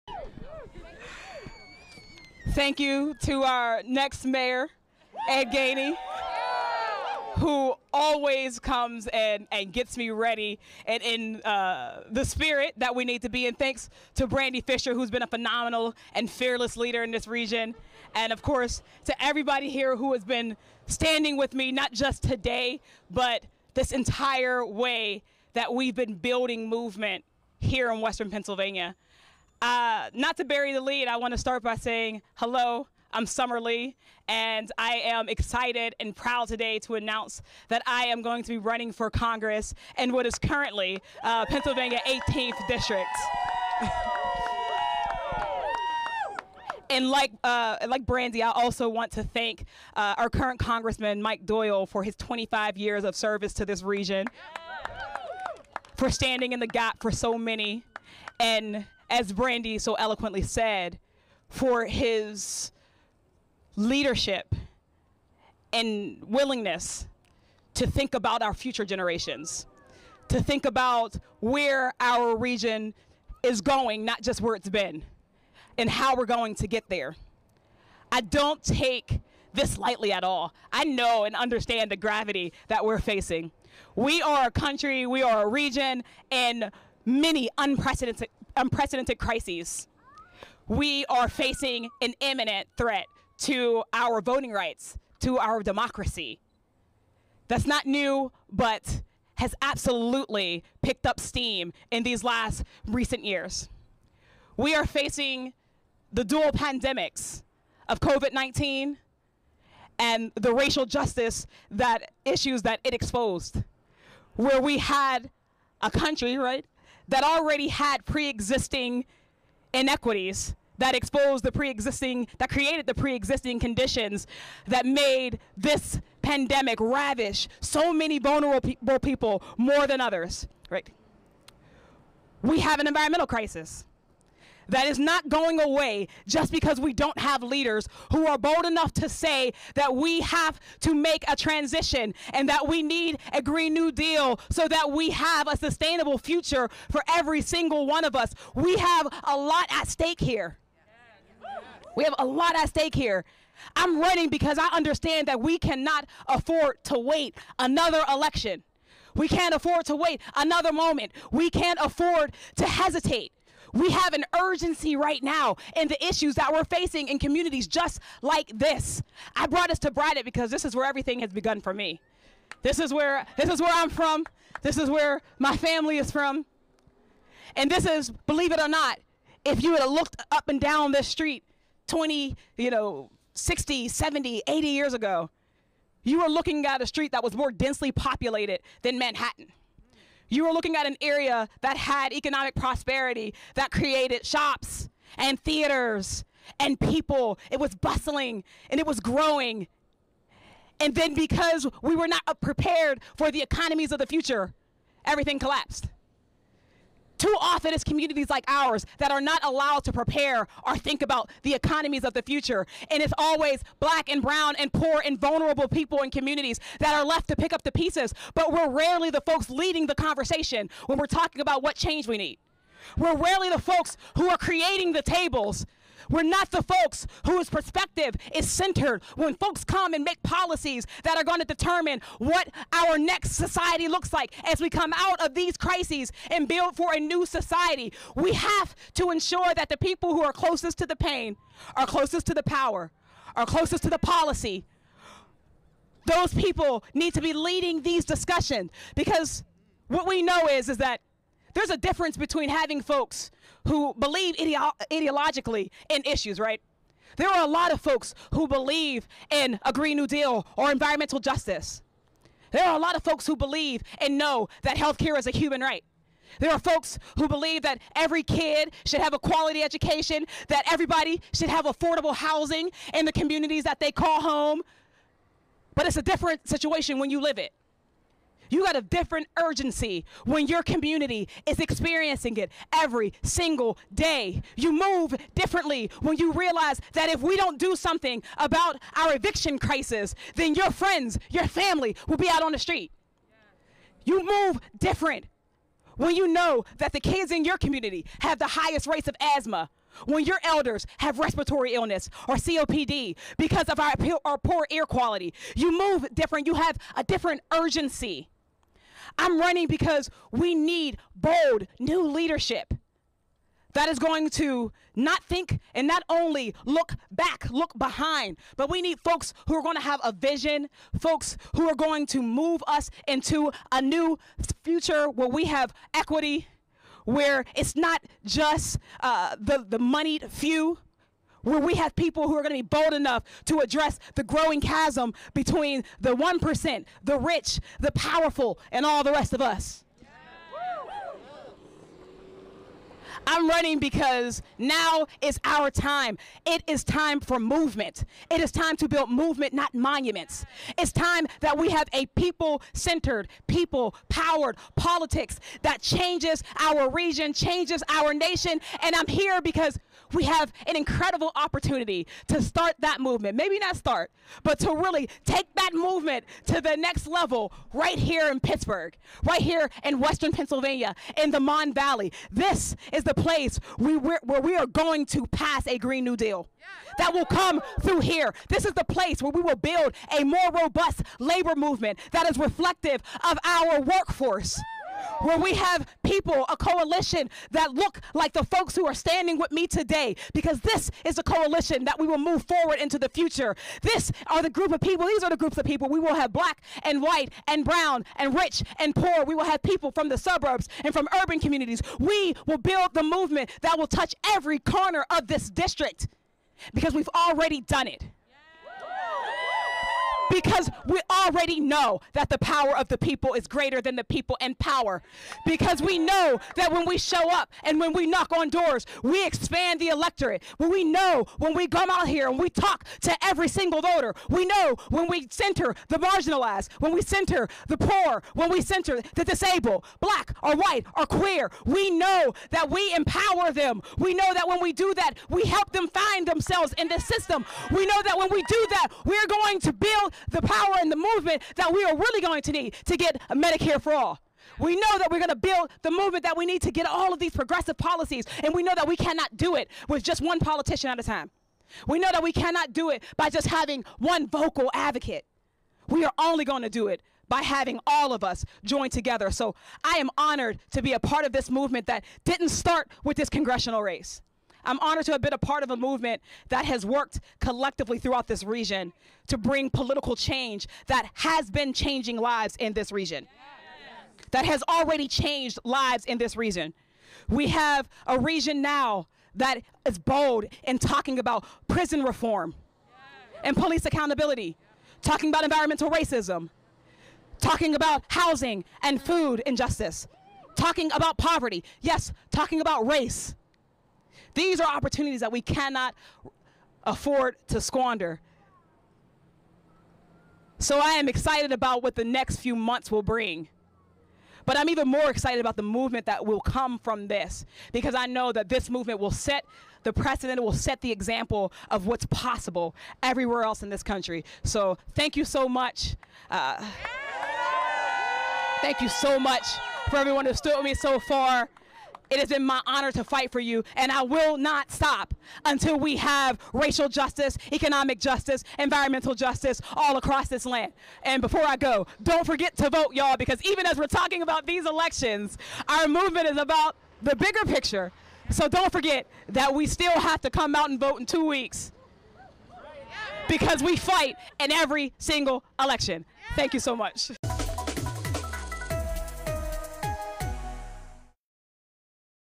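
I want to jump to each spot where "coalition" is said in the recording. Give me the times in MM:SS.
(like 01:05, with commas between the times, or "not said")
06:26, 06:31.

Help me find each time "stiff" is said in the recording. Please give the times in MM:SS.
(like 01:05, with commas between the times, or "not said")
not said.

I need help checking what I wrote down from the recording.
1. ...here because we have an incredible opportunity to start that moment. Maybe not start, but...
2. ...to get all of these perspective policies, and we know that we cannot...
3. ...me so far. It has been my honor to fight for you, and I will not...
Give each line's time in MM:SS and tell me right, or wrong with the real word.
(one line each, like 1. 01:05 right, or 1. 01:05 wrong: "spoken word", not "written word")
1. 05:59 wrong: "movement", not "moment"
2. 07:26 wrong: "progressive", not "perspective"
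3. 08:40 right.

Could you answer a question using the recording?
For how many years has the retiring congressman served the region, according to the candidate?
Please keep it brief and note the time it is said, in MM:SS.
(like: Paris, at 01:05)
25, at 00:52.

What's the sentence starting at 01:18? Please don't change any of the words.
I don't take this lightly at all.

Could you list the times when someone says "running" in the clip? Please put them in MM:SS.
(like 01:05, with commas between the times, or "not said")
00:38, 02:33, 05:09, 05:43.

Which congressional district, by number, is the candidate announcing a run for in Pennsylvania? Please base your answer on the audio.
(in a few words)
18th.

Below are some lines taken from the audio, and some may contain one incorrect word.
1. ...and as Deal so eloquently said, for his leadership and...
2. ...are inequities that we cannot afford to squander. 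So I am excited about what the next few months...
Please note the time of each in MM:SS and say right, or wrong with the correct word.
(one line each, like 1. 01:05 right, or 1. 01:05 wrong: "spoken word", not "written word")
1. 00:58 wrong: "Brandi", not "Deal"
2. 08:14 wrong: "opportunities", not "inequities".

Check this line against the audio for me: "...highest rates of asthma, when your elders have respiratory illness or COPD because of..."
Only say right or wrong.
right.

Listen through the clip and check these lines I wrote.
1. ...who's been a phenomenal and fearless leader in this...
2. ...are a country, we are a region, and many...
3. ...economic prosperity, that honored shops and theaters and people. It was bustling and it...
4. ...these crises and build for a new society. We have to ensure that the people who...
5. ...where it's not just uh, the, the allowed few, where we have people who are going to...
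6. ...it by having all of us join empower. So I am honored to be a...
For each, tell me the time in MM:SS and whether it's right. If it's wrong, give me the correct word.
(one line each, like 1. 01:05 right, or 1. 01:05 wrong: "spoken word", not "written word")
1. 00:14 right
2. 01:24 right
3. 03:12 wrong: "created", not "honored"
4. 03:55 right
5. 05:27 wrong: "moneyed", not "allowed"
6. 07:36 wrong: "together", not "empower".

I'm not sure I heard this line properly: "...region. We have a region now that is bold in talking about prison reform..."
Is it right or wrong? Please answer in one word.
right.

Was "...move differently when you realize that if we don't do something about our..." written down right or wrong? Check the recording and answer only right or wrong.
right.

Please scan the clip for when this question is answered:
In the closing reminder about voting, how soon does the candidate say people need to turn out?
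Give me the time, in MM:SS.
09:01.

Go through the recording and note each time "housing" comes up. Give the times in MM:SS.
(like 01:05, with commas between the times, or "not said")
04:32, 08:08.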